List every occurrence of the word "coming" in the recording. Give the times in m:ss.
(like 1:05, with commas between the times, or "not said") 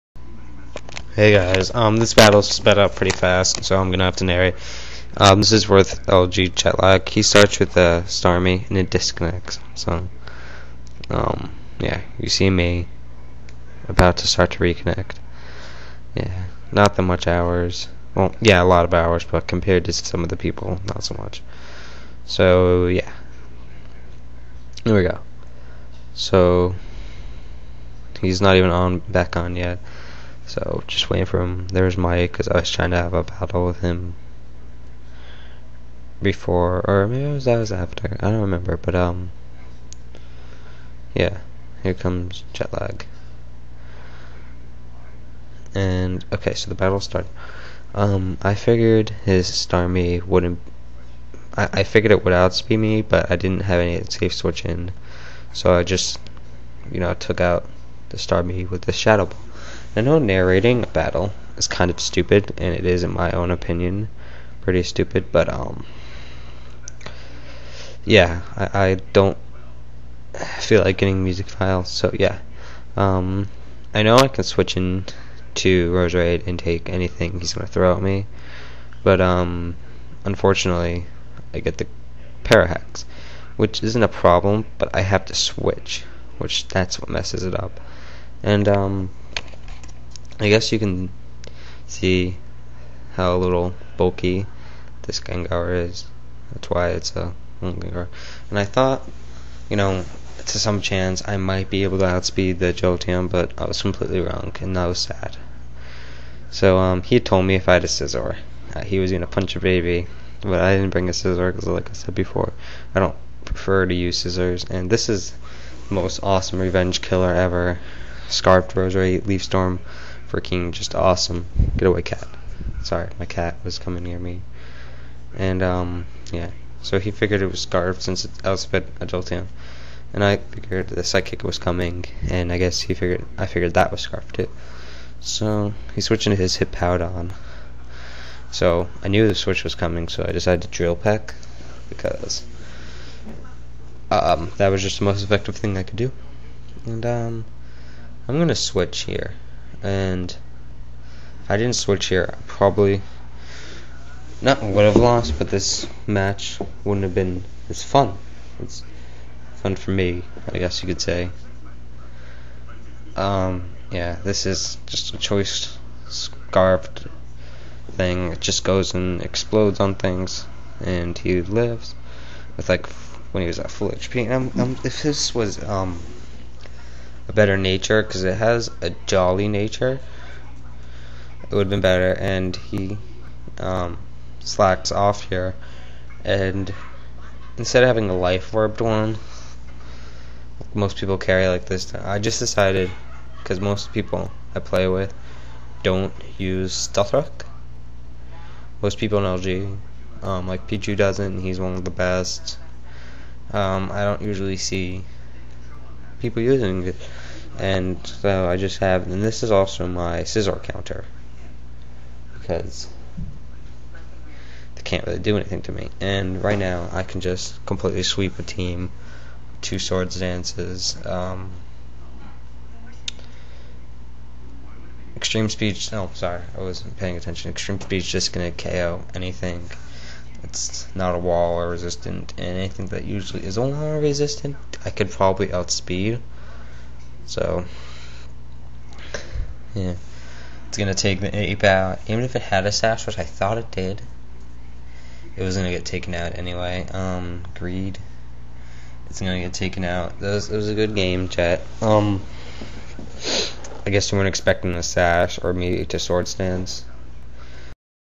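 2:03, 2:11, 2:19.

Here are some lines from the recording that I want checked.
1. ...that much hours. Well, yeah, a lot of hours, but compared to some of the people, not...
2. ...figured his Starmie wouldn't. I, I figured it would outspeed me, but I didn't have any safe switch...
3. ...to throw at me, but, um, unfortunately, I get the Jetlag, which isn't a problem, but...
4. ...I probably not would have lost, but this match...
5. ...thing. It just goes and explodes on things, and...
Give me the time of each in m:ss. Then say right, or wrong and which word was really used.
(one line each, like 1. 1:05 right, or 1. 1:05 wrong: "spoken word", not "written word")
1. 0:16 right
2. 0:48 right
3. 1:17 wrong: "Parahex", not "Jetlag"
4. 2:32 right
5. 2:47 right.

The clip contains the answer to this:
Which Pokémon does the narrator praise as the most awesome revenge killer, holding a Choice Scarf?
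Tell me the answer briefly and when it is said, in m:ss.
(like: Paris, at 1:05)
Roserade, at 1:58.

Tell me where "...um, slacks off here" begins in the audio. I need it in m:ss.
3:03.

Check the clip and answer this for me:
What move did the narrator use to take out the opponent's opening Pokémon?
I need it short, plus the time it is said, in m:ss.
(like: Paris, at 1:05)
Shadow Ball, at 0:58.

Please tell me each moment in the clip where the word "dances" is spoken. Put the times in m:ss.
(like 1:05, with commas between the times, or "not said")
3:40, 4:16.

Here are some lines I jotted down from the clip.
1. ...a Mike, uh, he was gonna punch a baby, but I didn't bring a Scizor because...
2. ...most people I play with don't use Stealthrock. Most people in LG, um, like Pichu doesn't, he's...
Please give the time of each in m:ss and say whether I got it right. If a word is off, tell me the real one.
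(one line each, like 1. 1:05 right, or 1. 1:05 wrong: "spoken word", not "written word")
1. 1:47 wrong: "Scizor", not "Mike"
2. 3:13 right.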